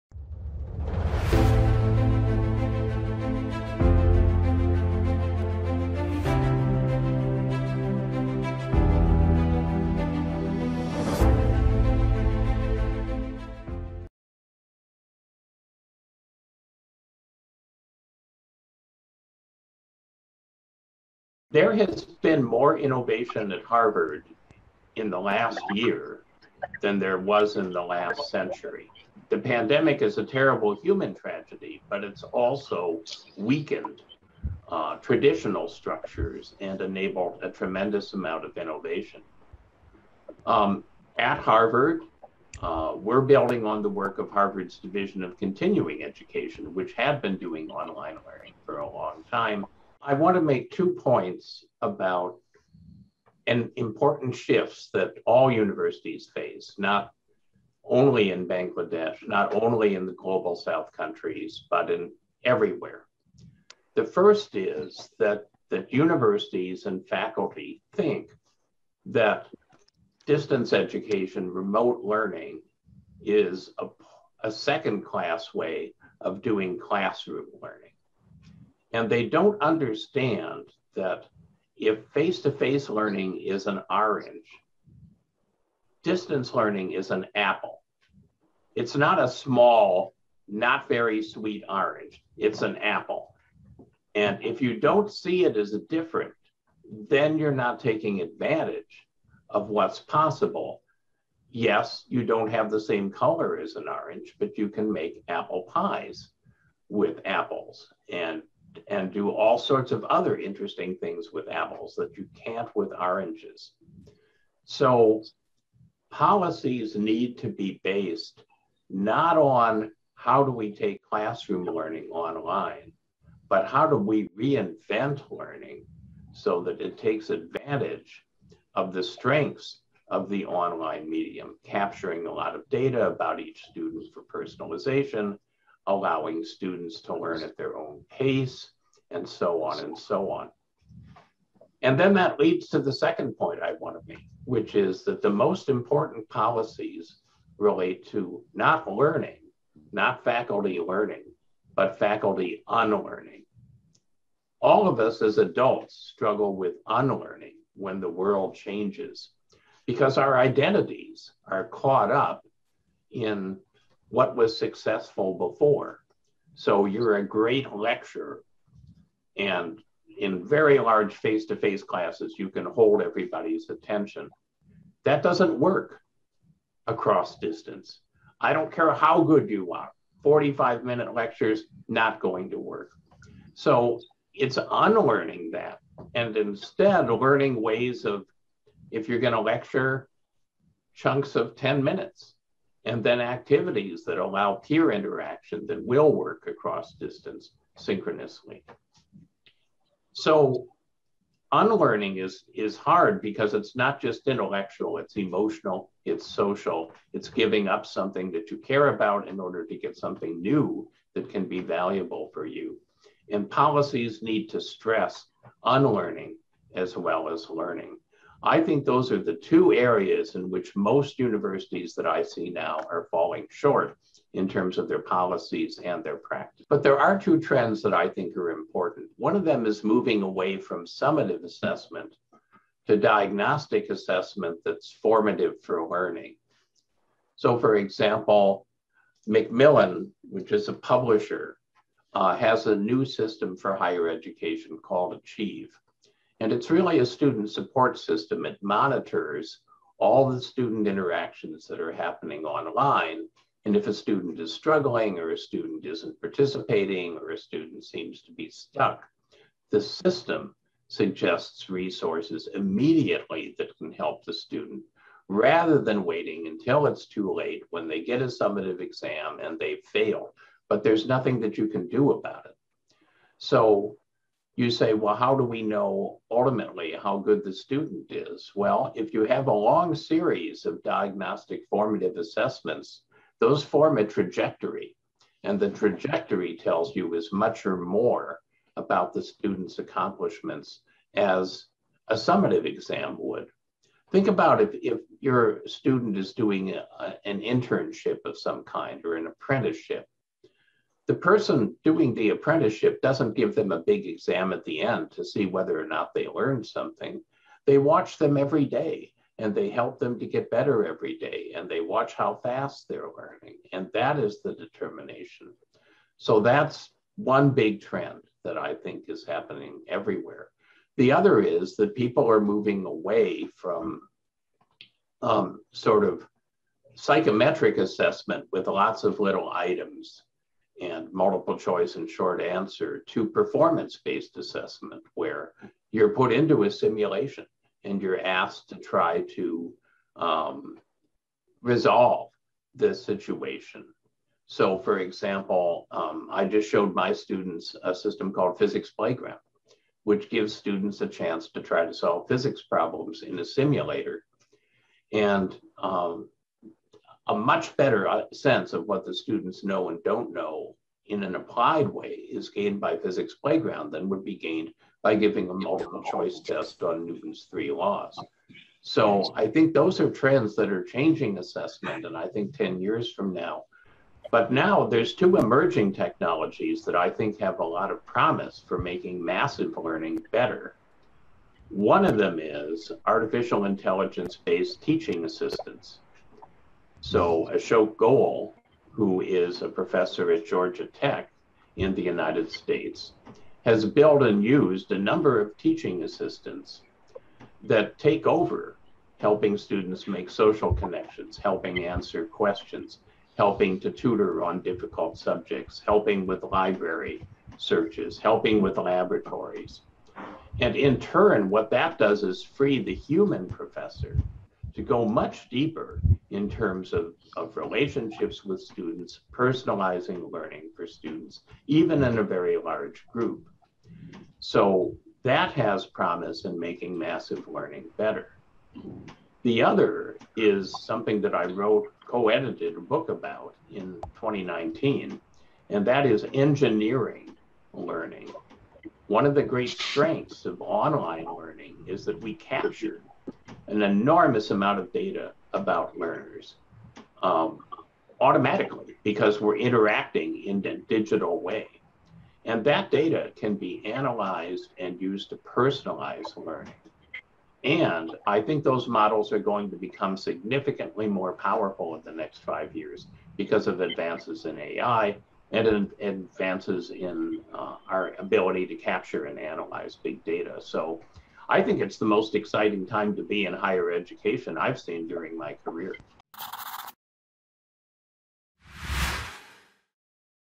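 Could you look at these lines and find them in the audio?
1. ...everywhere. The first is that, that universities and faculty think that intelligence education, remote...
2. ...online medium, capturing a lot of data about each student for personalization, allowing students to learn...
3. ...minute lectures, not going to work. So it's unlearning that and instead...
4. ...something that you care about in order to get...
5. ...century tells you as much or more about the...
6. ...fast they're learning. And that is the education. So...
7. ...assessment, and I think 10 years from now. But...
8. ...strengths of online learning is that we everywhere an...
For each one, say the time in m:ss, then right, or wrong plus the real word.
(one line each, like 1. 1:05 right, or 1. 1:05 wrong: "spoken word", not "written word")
1. 1:02 wrong: "distance", not "intelligence"
2. 2:10 right
3. 3:00 right
4. 3:27 right
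5. 4:45 wrong: "trajectory", not "century"
6. 5:12 wrong: "determination", not "education"
7. 6:11 right
8. 7:19 wrong: "capture", not "everywhere".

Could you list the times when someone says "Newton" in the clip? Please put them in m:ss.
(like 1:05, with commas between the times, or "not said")
6:07.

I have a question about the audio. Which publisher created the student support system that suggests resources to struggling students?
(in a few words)
Macmillan.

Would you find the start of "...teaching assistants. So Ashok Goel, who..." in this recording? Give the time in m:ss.
6:24.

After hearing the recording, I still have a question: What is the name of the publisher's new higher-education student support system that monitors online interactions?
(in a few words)
Achieve.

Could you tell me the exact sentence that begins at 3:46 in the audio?
But there are two trends that I think are important.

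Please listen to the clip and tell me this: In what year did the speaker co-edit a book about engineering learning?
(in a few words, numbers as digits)
2019.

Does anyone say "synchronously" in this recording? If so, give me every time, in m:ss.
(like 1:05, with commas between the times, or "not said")
3:17.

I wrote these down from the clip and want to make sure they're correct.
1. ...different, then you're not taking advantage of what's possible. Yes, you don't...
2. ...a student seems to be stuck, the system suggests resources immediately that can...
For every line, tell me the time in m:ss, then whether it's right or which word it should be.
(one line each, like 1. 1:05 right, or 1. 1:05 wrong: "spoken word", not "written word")
1. 1:35 right
2. 4:17 right.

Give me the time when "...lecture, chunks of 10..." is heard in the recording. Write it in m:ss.
3:09.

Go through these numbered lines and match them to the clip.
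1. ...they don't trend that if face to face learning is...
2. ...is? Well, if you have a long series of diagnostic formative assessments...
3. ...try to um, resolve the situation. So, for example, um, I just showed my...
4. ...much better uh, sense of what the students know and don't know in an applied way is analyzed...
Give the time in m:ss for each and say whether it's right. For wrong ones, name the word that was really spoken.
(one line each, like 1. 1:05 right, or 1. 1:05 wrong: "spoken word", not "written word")
1. 1:19 wrong: "understand", not "trend"
2. 4:38 right
3. 5:38 right
4. 5:57 wrong: "gained", not "analyzed".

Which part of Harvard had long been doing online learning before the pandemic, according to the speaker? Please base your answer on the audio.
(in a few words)
Division of Continuing Education.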